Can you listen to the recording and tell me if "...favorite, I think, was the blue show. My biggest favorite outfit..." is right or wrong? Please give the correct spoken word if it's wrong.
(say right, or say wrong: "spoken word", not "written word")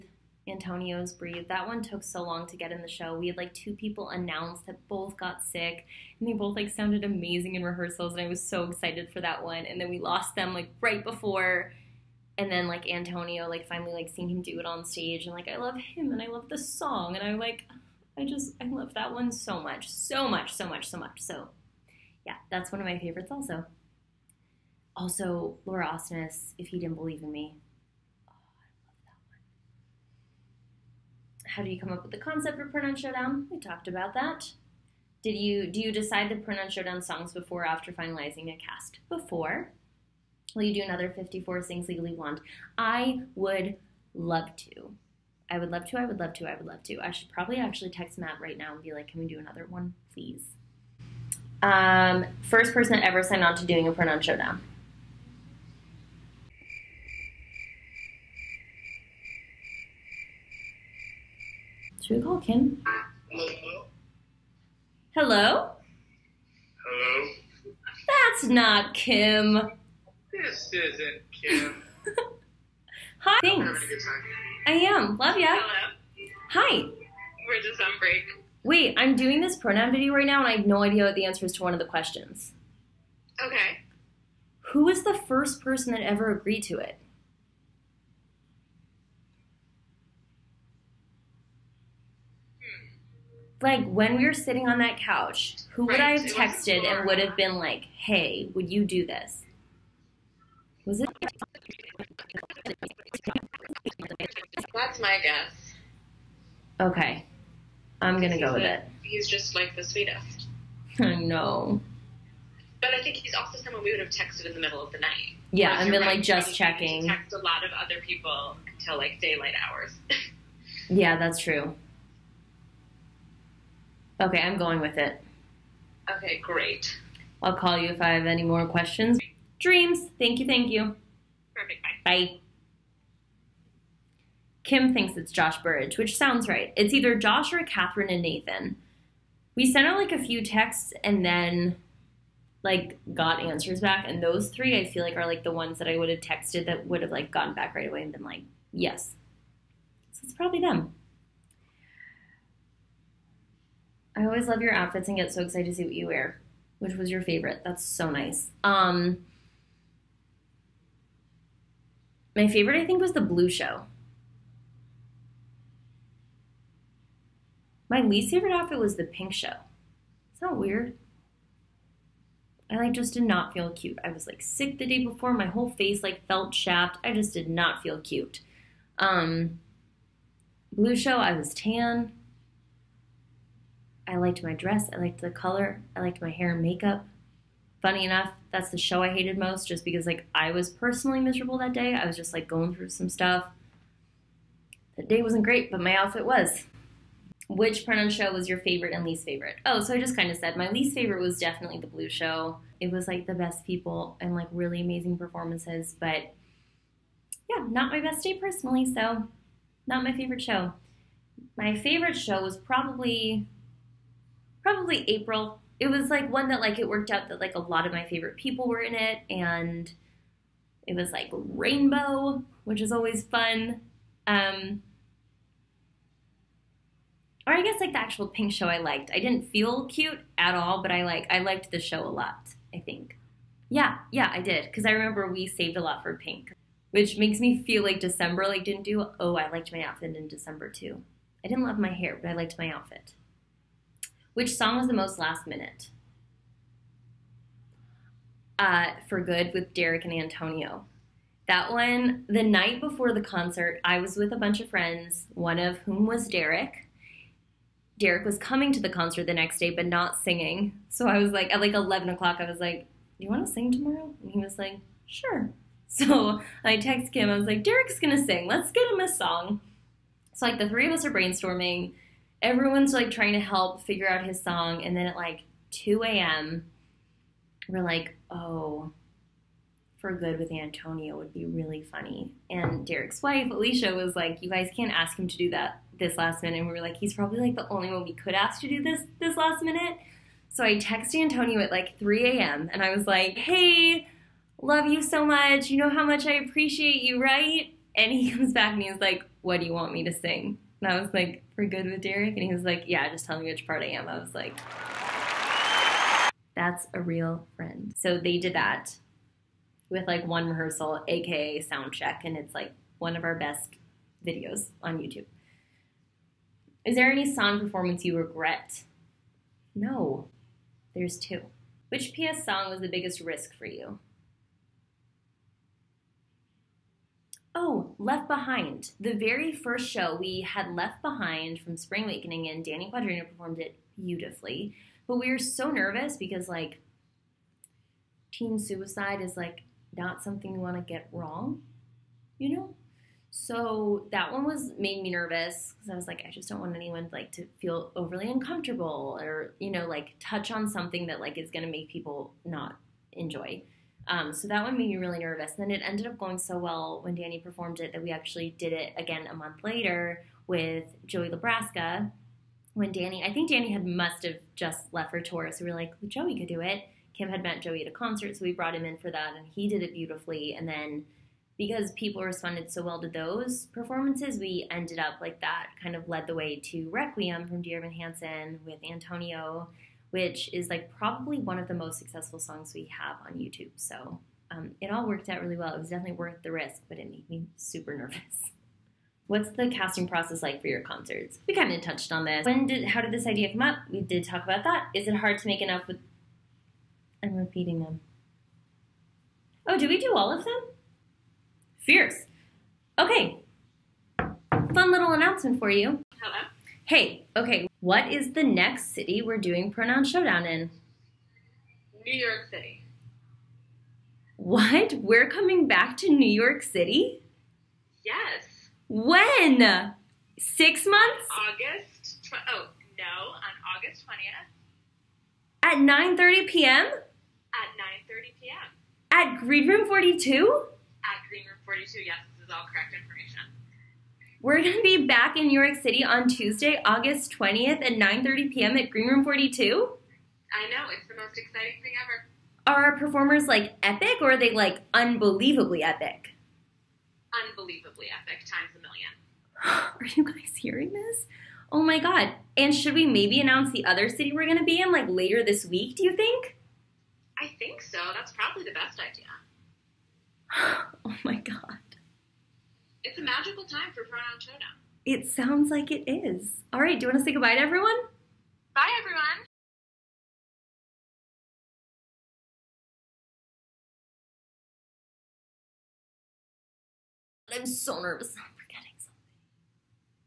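wrong: "least", not "biggest".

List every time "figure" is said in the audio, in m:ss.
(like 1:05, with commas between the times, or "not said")
4:33.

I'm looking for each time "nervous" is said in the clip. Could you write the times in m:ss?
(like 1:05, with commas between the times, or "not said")
5:35, 5:45, 5:55, 6:27, 7:58.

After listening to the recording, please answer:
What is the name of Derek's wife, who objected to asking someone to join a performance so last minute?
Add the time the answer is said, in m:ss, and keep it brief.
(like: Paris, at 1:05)
Alicia, at 4:43.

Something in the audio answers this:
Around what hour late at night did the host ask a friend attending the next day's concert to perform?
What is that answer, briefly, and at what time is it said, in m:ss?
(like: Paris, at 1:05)
11 o'clock, at 4:21.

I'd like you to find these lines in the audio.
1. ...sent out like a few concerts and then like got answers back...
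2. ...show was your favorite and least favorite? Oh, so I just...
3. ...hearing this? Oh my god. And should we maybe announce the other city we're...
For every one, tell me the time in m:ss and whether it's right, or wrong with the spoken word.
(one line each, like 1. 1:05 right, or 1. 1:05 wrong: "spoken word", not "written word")
1. 2:19 wrong: "texts", not "concerts"
2. 3:18 right
3. 7:30 right.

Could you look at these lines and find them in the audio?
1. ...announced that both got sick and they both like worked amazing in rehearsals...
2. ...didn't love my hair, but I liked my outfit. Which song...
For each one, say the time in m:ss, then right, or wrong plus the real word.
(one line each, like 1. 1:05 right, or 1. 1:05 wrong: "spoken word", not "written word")
1. 0:04 wrong: "sounded", not "worked"
2. 4:01 right.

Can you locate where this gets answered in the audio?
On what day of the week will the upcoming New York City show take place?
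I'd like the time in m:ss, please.
7:16.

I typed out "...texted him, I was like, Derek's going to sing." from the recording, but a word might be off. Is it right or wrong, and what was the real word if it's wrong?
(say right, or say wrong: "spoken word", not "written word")
right.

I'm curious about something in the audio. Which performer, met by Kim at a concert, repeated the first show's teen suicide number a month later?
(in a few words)
Joey Nebraska.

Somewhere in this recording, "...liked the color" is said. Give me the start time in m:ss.
3:04.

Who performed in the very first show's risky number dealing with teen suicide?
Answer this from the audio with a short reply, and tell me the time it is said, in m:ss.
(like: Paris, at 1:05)
Danny Quadrino, at 5:32.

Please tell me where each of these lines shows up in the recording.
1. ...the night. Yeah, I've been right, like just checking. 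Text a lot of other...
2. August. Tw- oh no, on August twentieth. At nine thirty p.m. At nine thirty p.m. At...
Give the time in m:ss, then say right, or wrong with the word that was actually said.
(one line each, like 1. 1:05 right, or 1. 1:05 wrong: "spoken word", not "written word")
1. 1:54 right
2. 7:01 right.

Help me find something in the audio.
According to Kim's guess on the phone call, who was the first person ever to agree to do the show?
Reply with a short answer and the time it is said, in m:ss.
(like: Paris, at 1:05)
Josh Burridge, at 2:15.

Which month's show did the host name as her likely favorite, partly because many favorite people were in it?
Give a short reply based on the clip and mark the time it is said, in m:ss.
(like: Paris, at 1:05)
April, at 3:35.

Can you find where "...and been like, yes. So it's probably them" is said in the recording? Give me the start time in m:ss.
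2:28.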